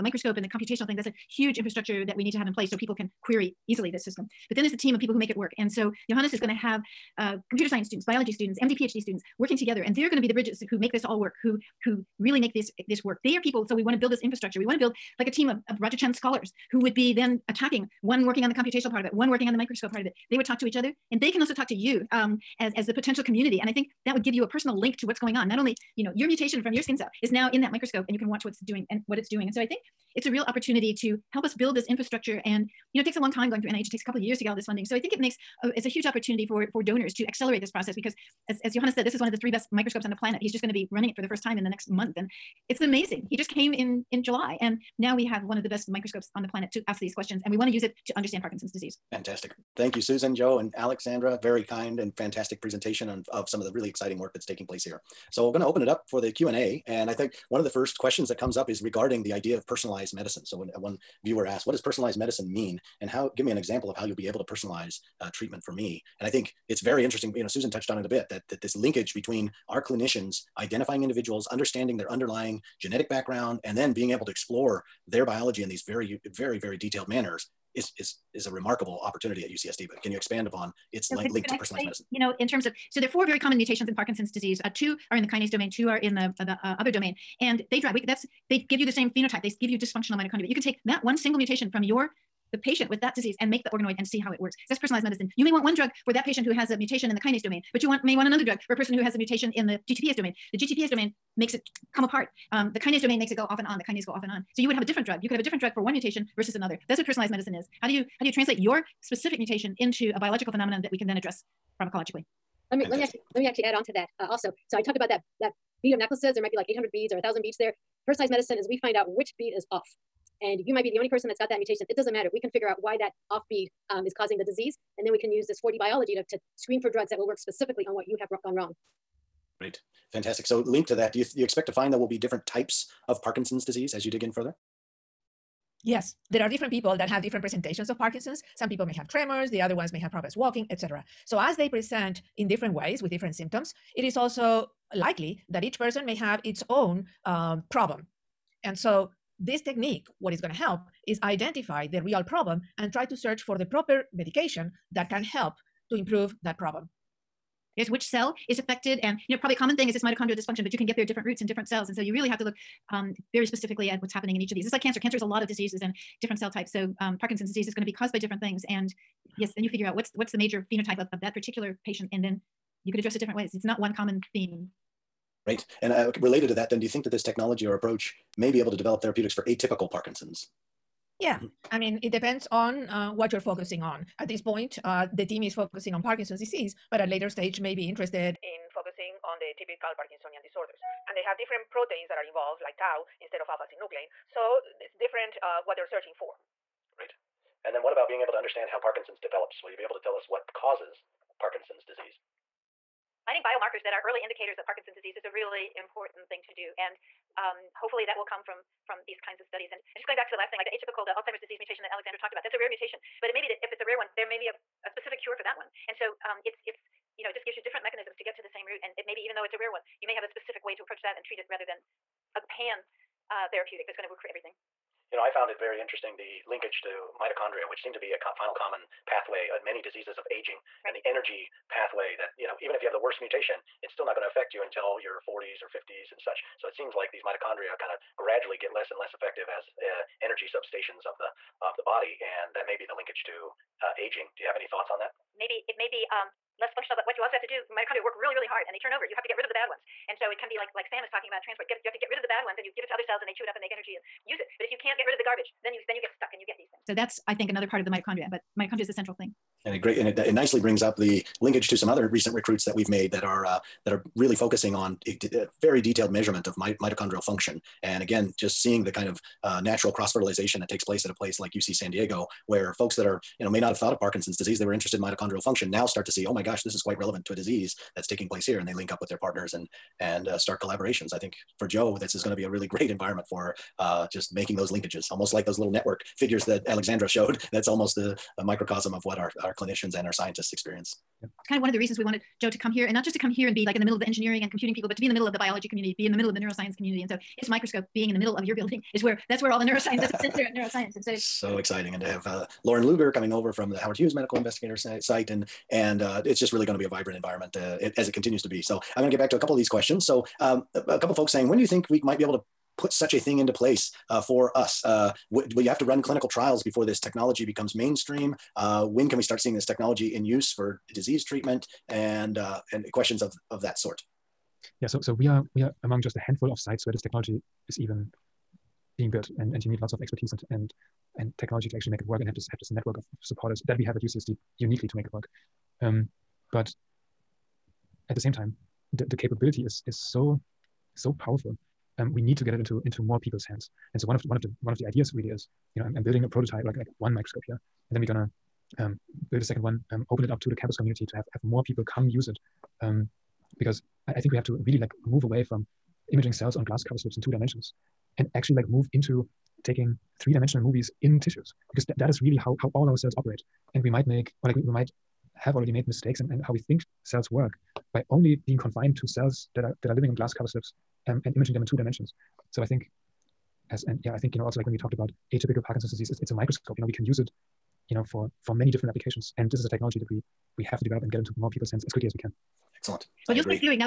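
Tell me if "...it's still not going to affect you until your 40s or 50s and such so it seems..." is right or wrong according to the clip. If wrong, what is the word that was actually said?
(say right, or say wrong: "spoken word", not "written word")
right.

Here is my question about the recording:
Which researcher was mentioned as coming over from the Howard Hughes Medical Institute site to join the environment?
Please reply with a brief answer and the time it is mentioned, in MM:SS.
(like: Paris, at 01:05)
Loren Looger, at 05:02.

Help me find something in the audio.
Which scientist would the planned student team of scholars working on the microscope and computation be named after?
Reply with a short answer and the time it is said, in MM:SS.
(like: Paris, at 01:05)
Roger Tsien, at 00:15.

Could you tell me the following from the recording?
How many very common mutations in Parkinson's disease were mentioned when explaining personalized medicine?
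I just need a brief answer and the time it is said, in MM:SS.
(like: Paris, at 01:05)
4, at 01:23.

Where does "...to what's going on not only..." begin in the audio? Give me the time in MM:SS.
00:24.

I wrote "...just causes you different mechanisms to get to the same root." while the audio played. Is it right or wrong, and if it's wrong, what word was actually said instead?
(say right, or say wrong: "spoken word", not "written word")
wrong: "gives", not "causes".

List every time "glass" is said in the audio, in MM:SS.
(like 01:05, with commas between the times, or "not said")
05:56, 06:10.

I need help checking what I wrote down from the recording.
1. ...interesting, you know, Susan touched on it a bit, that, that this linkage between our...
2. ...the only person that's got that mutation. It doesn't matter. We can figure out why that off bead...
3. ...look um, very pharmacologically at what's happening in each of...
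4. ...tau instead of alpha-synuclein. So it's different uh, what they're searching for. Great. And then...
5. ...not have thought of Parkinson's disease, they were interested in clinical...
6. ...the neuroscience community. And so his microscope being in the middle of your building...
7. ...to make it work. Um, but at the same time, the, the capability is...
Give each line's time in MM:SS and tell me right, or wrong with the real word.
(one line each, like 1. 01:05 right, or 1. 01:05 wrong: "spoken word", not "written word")
1. 01:07 right
2. 02:00 right
3. 02:42 wrong: "specifically", not "pharmacologically"
4. 03:12 right
5. 04:33 wrong: "mitochondrial", not "clinical"
6. 04:56 right
7. 05:34 right.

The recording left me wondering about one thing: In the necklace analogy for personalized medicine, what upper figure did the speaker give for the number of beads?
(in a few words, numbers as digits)
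1,000.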